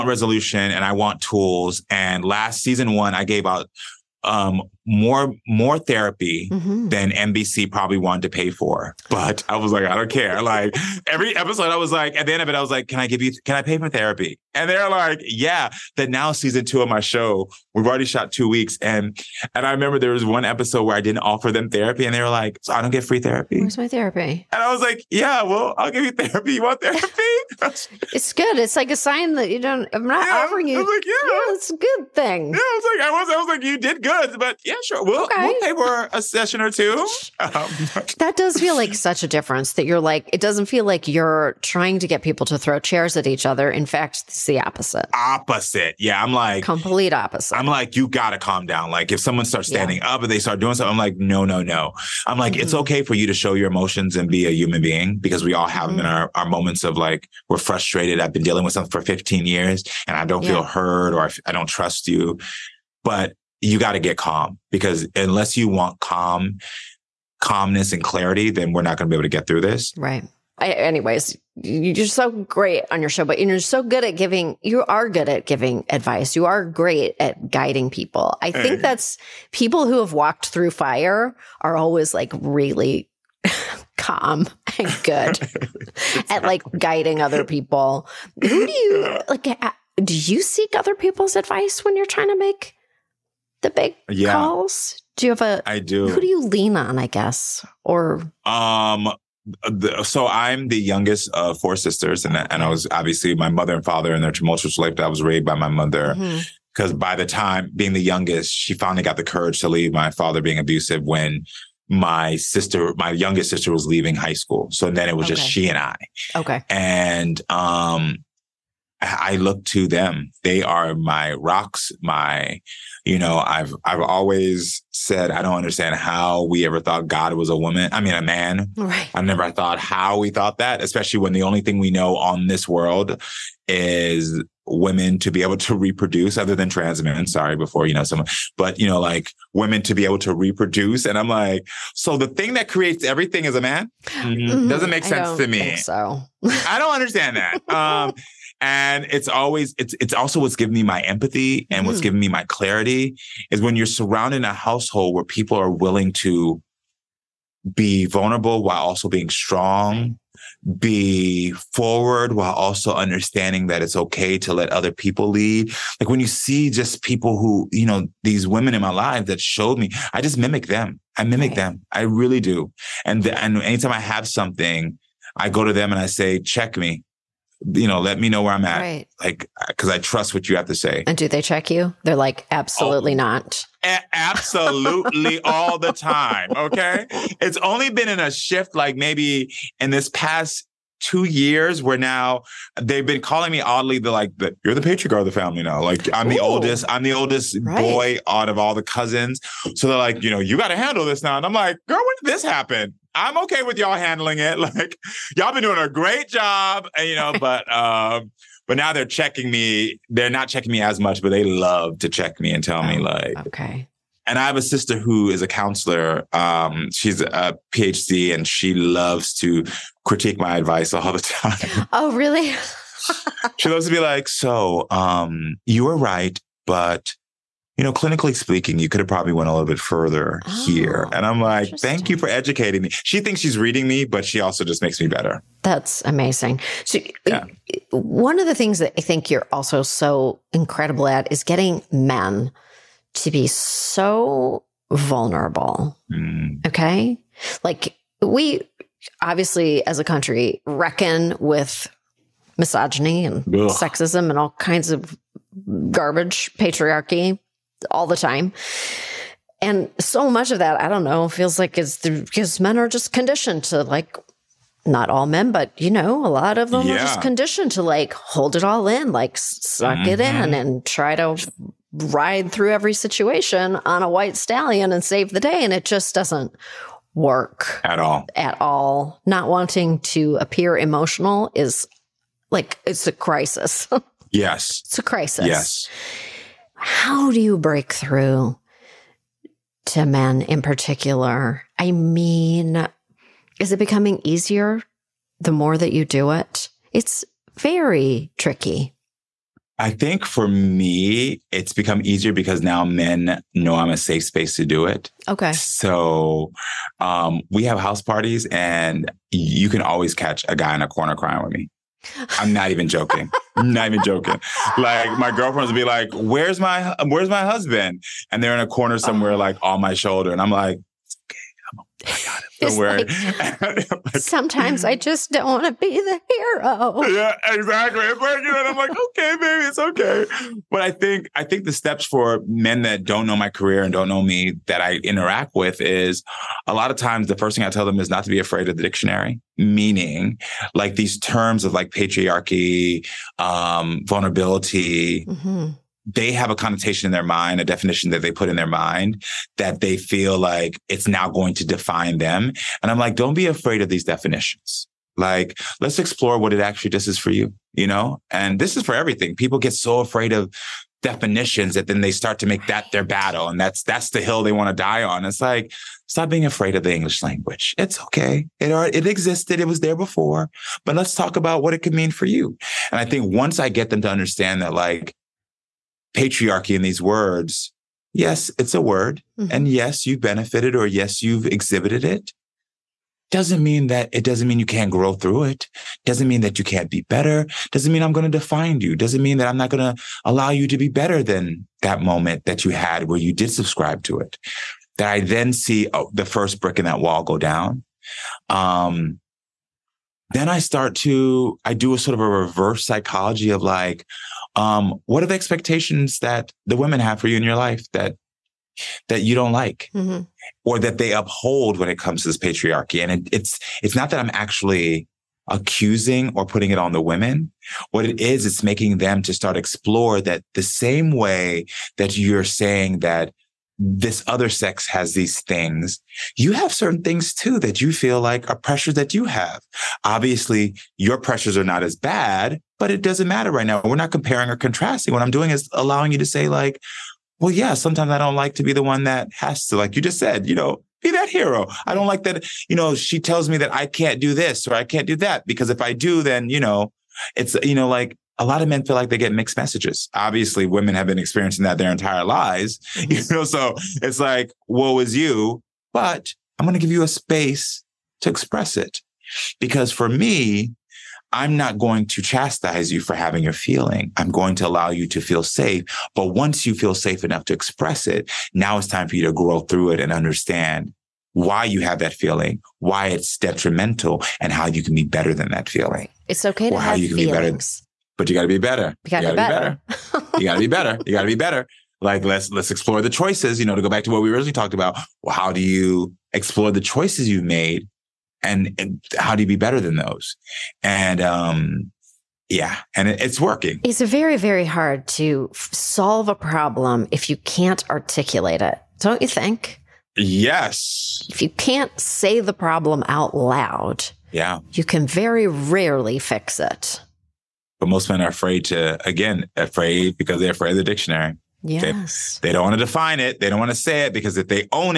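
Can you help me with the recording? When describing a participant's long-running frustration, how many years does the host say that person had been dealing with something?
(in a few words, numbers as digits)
15 years.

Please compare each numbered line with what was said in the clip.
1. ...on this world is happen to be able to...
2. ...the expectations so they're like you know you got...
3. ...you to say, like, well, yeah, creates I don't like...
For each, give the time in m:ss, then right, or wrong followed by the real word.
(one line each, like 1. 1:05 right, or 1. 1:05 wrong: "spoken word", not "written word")
1. 2:12 wrong: "women", not "happen"
2. 3:18 wrong: "cousins", not "expectations"
3. 7:16 wrong: "sometimes", not "creates".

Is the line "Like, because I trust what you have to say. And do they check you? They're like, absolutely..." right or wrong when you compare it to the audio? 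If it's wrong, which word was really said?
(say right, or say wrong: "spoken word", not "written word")
right.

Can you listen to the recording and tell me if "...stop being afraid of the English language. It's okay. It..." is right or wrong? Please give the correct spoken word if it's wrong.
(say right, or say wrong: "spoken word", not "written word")
right.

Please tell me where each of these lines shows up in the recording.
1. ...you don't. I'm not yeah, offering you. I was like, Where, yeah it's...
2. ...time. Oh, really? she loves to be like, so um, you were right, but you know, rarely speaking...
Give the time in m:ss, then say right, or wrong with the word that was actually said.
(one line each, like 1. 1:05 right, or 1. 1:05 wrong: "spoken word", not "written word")
1. 0:29 wrong: "Yeah", not "Where"
2. 3:41 wrong: "clinically", not "rarely".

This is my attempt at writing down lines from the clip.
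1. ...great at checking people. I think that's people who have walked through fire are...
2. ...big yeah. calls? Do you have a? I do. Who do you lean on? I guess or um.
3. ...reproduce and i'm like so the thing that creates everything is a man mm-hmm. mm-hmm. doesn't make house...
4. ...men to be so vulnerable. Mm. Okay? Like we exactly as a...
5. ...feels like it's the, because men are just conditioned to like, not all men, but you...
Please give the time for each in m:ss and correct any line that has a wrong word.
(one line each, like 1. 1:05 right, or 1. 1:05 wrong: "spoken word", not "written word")
1. 1:16 wrong: "guiding", not "checking"
2. 1:33 right
3. 2:20 wrong: "sense", not "house"
4. 4:01 wrong: "obviously", not "exactly"
5. 4:21 right.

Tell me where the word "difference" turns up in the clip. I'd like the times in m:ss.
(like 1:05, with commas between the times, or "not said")
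0:39.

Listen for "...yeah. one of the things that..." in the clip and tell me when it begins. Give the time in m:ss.
3:57.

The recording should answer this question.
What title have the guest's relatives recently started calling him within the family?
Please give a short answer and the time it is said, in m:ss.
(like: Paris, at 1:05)
The patriarch, at 3:14.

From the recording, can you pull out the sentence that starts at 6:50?
or that they uphold when it comes to this patriarchy?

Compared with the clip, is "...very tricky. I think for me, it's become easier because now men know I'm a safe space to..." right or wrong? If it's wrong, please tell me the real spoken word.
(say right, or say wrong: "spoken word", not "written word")
right.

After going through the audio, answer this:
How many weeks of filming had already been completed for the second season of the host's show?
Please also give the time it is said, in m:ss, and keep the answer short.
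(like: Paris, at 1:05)
2 weeks, at 0:18.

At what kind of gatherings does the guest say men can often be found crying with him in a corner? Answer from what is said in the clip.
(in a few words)
House parties.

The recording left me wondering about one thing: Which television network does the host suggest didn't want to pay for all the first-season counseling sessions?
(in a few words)
NBC.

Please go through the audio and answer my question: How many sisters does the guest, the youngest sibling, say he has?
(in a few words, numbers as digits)
4.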